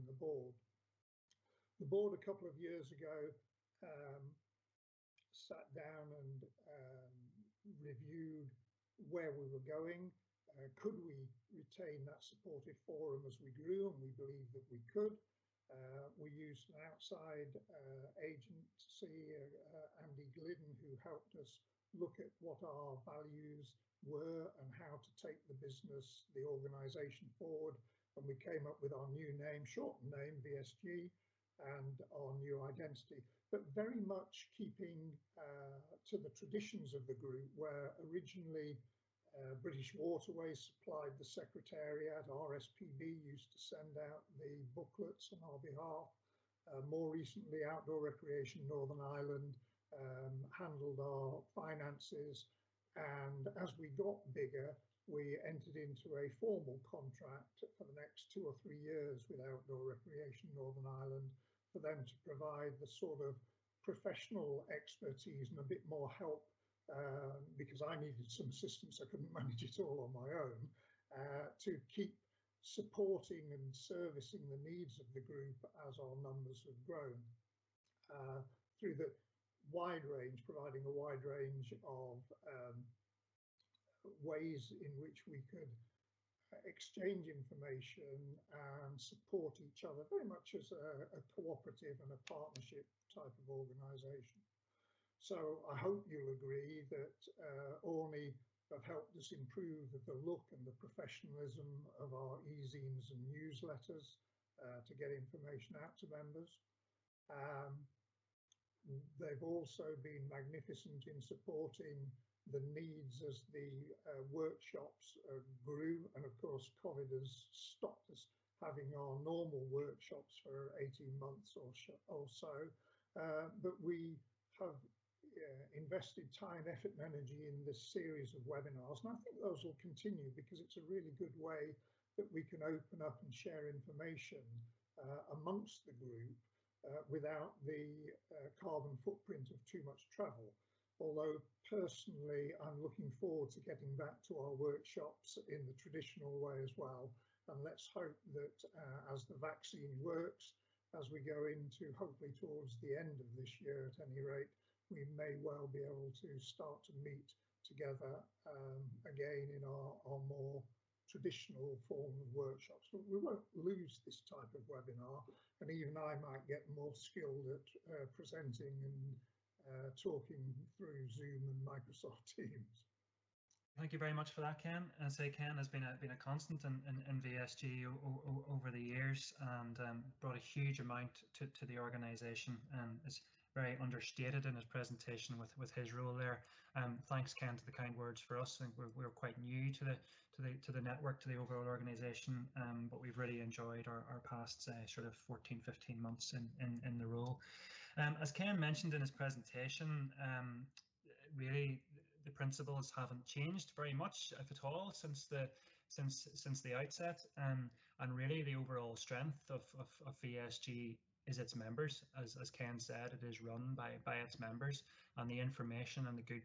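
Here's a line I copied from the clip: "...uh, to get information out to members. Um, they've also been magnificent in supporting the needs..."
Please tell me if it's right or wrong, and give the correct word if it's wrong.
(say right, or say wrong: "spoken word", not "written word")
right.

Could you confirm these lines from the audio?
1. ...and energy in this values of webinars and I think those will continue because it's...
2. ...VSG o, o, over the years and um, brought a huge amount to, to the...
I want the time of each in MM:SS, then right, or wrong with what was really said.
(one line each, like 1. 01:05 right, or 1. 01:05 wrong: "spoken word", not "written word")
1. 02:06 wrong: "series", not "values"
2. 02:57 right.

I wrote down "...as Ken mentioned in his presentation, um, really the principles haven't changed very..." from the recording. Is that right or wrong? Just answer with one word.
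right.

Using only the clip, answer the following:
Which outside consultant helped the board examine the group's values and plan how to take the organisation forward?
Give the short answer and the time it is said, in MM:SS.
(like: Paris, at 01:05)
Andy Glidden, at 00:20.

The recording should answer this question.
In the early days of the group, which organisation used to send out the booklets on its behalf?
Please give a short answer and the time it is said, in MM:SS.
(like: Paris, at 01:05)
RSPB, at 00:42.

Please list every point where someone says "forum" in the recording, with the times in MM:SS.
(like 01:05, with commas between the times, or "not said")
00:12.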